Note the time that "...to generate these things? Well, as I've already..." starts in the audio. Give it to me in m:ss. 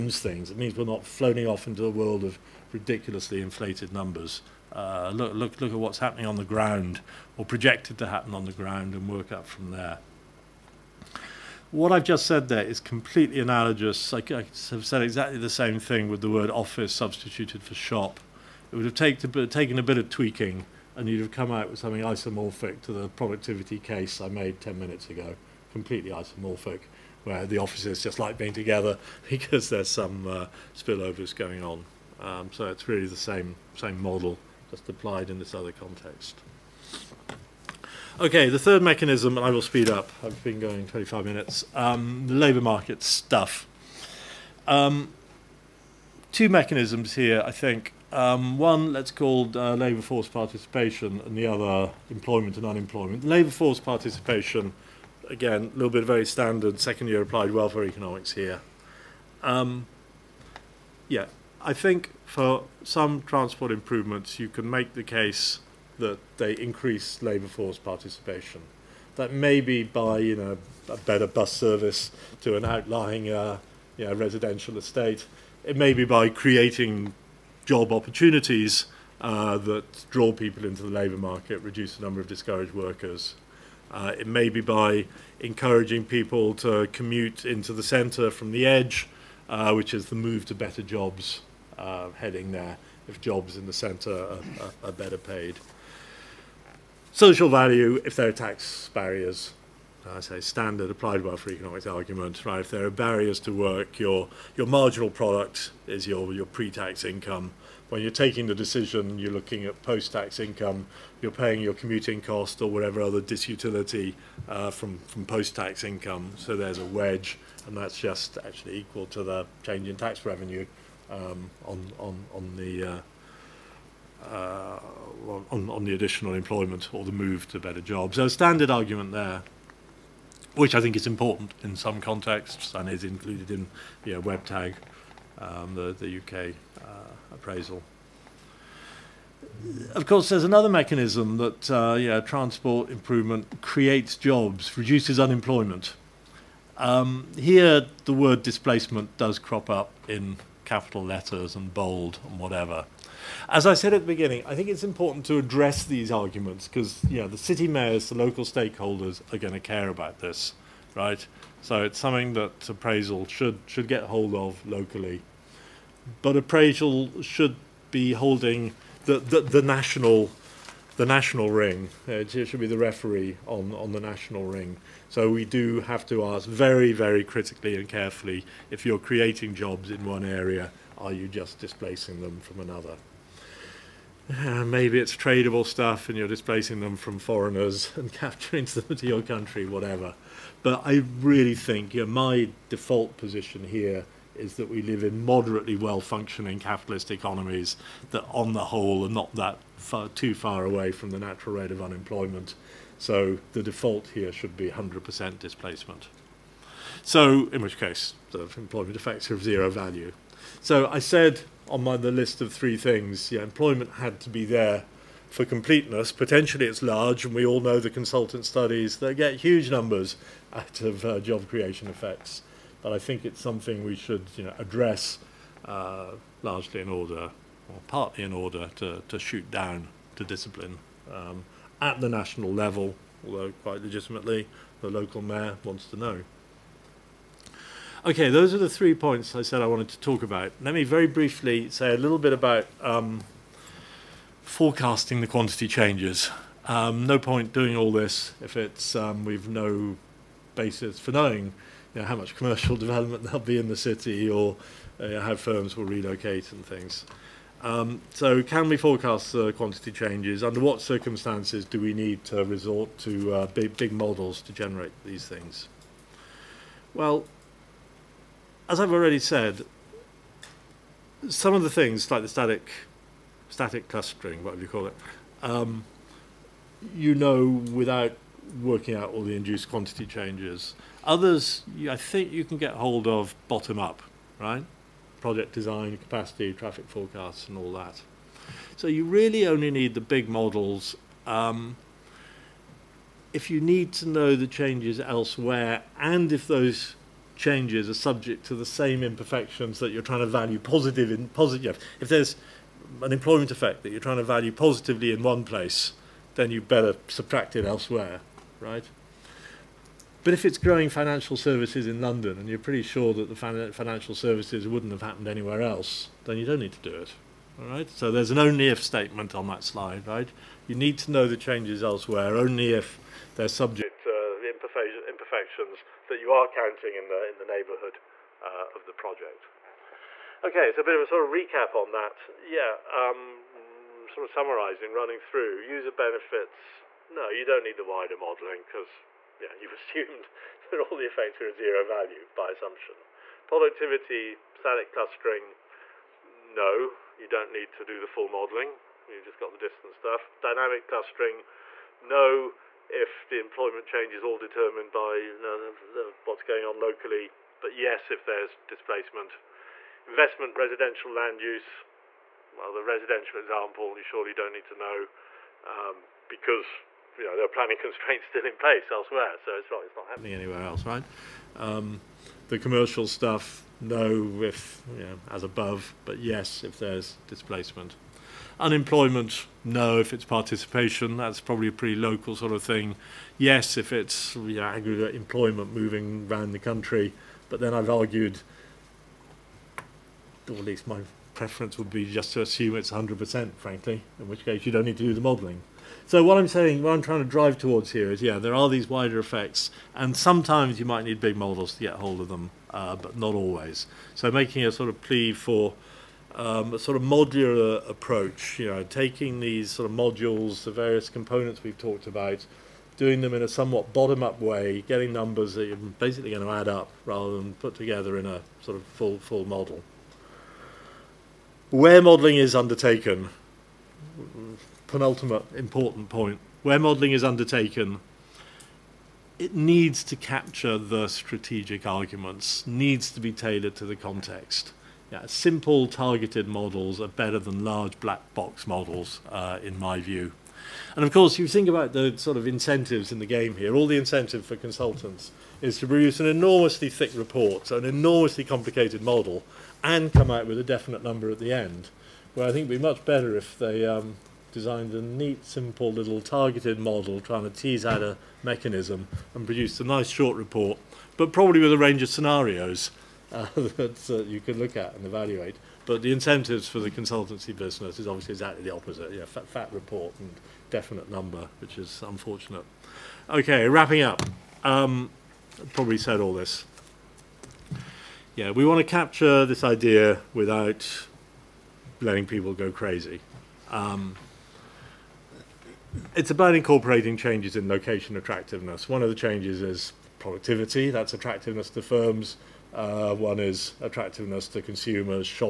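4:24.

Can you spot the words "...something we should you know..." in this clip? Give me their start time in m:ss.
3:43.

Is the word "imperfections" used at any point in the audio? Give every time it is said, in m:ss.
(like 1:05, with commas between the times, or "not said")
4:59, 5:24.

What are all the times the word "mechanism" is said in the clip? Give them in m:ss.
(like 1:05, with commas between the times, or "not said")
0:38, 0:46, 2:20, 7:38.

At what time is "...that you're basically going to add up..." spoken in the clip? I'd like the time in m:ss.
6:55.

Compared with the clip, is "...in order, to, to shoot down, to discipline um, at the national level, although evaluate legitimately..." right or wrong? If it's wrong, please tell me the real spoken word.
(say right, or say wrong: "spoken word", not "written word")
wrong: "quite", not "evaluate".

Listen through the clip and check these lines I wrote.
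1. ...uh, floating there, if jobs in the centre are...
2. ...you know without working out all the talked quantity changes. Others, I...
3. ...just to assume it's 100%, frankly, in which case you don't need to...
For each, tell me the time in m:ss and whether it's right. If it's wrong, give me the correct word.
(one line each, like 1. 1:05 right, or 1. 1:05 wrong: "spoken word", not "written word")
1. 1:31 wrong: "heading", not "floating"
2. 4:36 wrong: "induced", not "talked"
3. 6:32 right.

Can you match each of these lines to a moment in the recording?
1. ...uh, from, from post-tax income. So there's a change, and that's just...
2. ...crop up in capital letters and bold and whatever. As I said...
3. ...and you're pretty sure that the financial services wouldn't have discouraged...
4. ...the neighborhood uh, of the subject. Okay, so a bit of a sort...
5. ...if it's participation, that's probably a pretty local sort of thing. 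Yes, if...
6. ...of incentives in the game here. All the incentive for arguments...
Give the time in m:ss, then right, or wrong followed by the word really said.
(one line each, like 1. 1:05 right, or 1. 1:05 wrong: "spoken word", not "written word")
1. 1:54 wrong: "wedge", not "change"
2. 2:29 right
3. 5:12 wrong: "happened", not "discouraged"
4. 5:27 wrong: "project", not "subject"
5. 6:19 right
6. 7:22 wrong: "consultants", not "arguments".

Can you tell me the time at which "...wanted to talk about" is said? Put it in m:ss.
3:59.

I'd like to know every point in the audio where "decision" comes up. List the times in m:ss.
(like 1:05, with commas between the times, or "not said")
1:48.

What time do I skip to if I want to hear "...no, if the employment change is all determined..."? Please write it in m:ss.
5:51.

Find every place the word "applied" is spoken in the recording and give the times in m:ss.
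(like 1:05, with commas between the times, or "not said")
0:34, 0:57, 1:40.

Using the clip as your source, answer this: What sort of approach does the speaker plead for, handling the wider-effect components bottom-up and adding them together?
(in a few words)
modular approach.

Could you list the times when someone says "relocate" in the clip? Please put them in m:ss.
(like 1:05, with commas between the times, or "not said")
4:15.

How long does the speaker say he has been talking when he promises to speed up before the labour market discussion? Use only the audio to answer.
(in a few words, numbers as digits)
25 minutes.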